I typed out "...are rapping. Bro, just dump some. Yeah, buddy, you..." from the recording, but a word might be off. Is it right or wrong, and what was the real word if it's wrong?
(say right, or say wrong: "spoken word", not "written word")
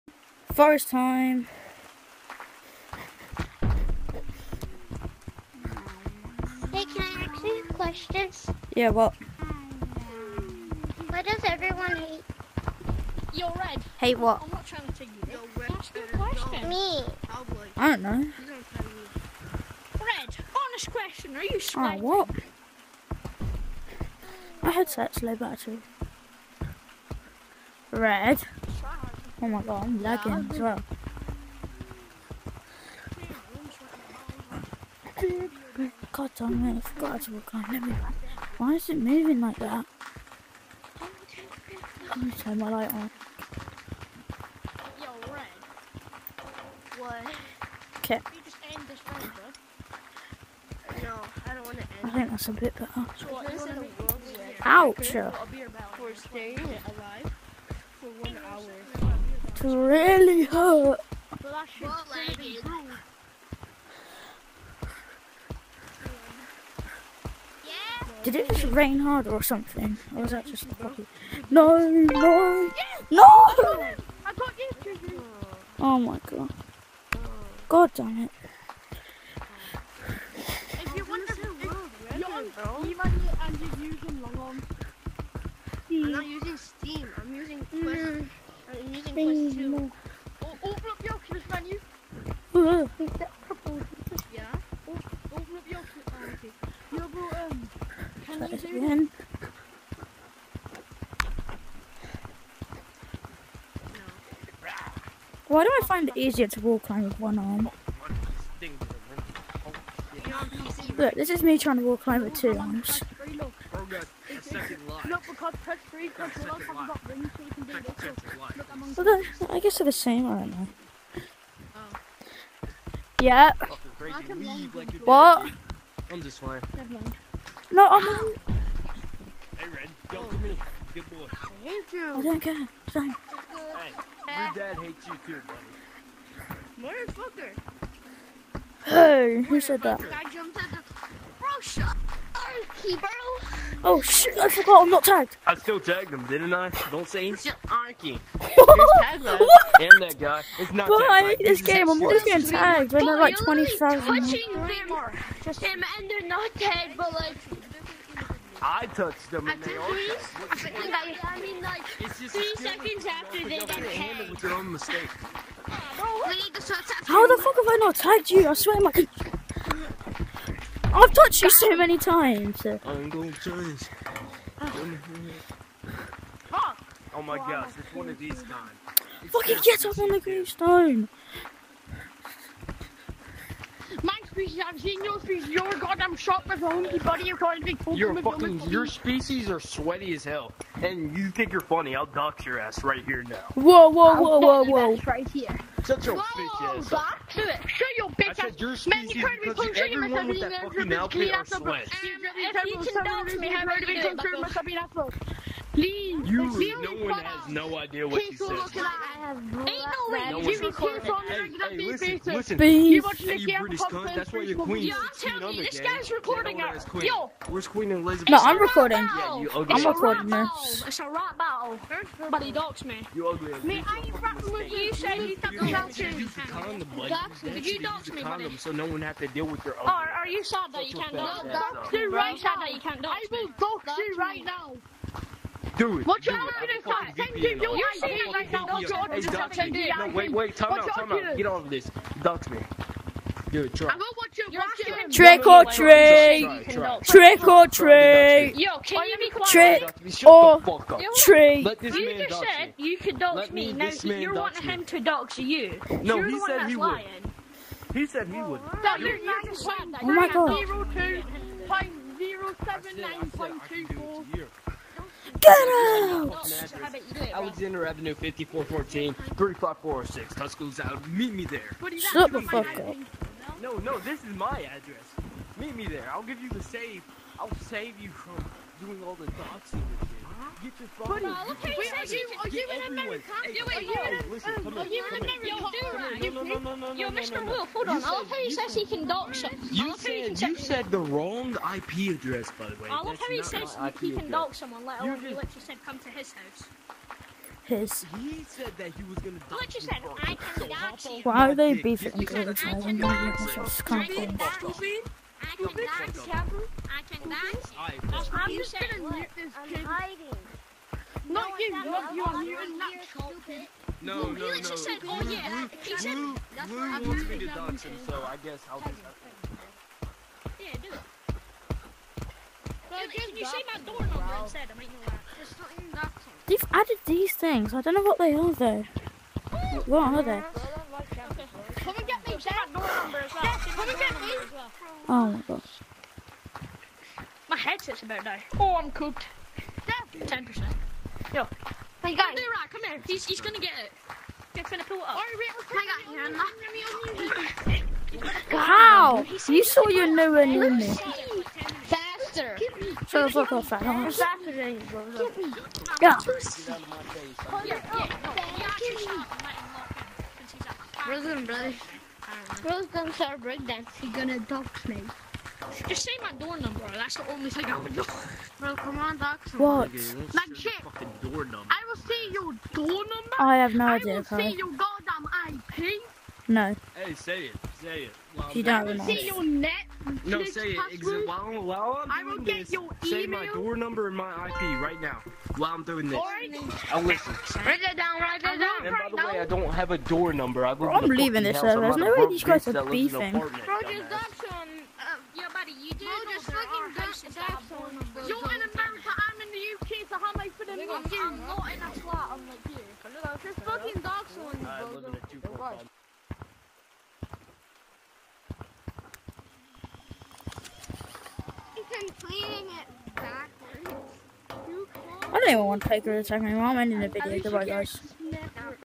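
wrong: "beefing", not "rapping".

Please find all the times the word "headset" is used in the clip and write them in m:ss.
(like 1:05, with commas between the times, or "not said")
0:24, 5:37.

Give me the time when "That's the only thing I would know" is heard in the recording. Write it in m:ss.
6:06.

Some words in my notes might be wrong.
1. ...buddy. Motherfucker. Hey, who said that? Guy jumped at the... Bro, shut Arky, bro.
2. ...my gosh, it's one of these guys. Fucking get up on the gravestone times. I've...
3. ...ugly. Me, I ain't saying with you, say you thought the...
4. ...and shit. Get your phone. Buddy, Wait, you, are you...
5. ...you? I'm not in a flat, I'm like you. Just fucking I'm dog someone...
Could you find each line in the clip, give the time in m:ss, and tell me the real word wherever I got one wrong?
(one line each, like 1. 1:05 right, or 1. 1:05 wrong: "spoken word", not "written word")
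1. 2:15 right
2. 2:57 wrong: "species", not "times"
3. 3:43 wrong: "rapping", not "saying"
4. 4:39 right
5. 6:41 right.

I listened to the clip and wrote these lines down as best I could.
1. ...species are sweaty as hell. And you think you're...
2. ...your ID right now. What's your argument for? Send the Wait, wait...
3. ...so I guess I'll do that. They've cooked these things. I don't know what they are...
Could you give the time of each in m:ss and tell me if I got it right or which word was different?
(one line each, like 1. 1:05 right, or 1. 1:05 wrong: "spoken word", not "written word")
1. 3:08 right
2. 3:57 right
3. 5:18 wrong: "added", not "cooked".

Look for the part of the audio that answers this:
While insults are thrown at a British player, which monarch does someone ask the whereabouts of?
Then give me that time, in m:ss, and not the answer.
3:37.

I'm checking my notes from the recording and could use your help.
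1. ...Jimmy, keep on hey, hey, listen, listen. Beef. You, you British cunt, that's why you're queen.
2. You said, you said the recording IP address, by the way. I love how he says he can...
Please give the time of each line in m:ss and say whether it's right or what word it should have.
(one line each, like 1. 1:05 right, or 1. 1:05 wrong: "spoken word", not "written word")
1. 3:30 right
2. 4:49 wrong: "wrong", not "recording".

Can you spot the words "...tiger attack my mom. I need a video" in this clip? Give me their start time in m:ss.
6:56.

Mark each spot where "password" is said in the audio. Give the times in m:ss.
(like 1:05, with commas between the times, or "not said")
6:20.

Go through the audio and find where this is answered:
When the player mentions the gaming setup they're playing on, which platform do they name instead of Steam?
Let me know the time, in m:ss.
1:28.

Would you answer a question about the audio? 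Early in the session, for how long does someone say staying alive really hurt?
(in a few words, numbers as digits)
1 hour.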